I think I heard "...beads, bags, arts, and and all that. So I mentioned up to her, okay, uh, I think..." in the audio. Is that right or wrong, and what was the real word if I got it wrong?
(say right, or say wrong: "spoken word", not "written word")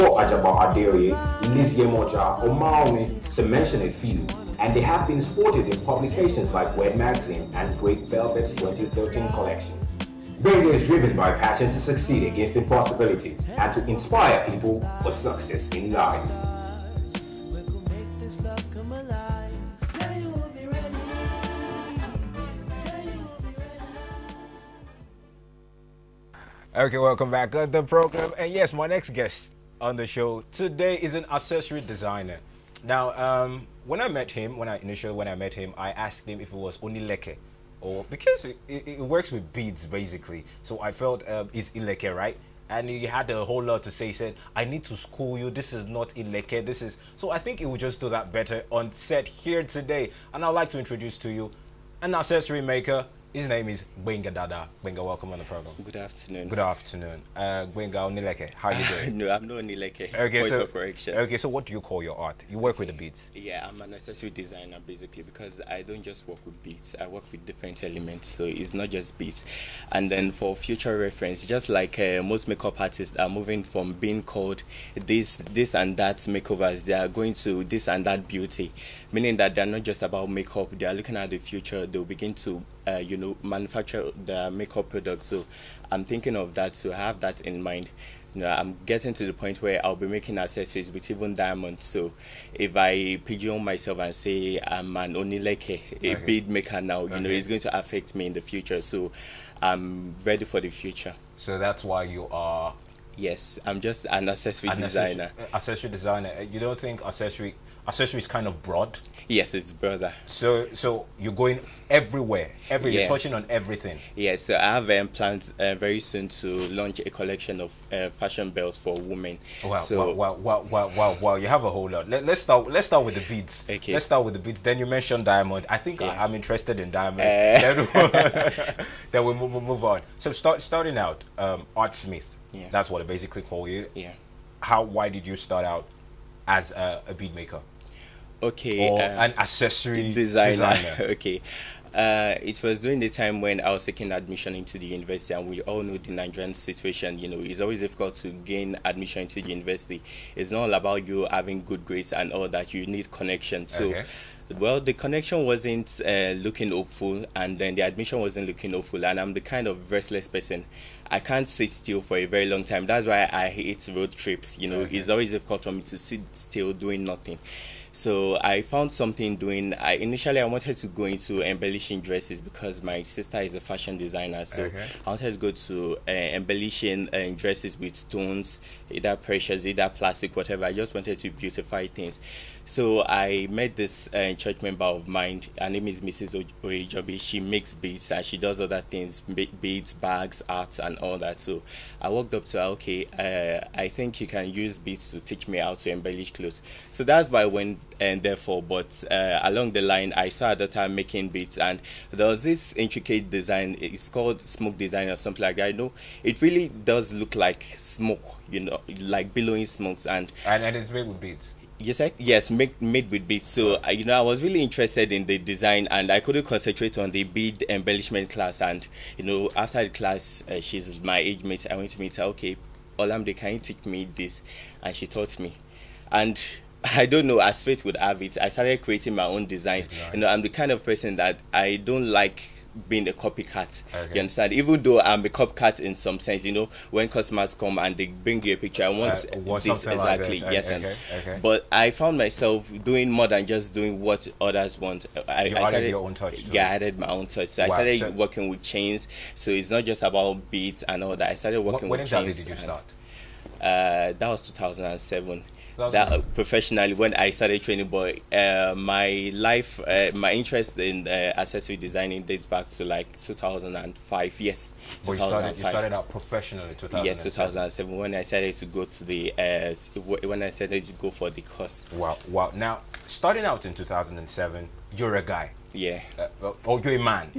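wrong: "walked", not "mentioned".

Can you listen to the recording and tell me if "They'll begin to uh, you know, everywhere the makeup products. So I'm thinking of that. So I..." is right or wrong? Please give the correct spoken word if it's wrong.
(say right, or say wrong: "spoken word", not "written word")
wrong: "manufacture", not "everywhere".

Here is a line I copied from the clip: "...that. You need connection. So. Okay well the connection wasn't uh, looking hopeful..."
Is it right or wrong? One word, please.
right.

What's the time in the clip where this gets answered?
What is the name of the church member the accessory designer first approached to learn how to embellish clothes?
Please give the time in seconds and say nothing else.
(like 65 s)
186 s.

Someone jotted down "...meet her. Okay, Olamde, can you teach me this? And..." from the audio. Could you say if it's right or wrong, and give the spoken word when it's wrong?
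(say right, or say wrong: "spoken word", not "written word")
right.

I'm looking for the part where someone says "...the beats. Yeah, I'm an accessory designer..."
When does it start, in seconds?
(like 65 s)
62 s.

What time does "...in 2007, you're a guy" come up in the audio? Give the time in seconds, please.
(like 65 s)
273 s.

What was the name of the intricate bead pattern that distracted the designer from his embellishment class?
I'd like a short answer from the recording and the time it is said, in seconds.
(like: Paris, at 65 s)
Smoke design, at 204 s.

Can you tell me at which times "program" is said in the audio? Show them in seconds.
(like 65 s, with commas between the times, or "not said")
27 s, 55 s.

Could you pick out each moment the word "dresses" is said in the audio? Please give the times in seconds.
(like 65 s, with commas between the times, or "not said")
171 s, 177 s.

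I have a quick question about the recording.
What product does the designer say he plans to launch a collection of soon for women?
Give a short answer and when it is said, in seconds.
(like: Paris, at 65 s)
Fashion belts, at 118 s.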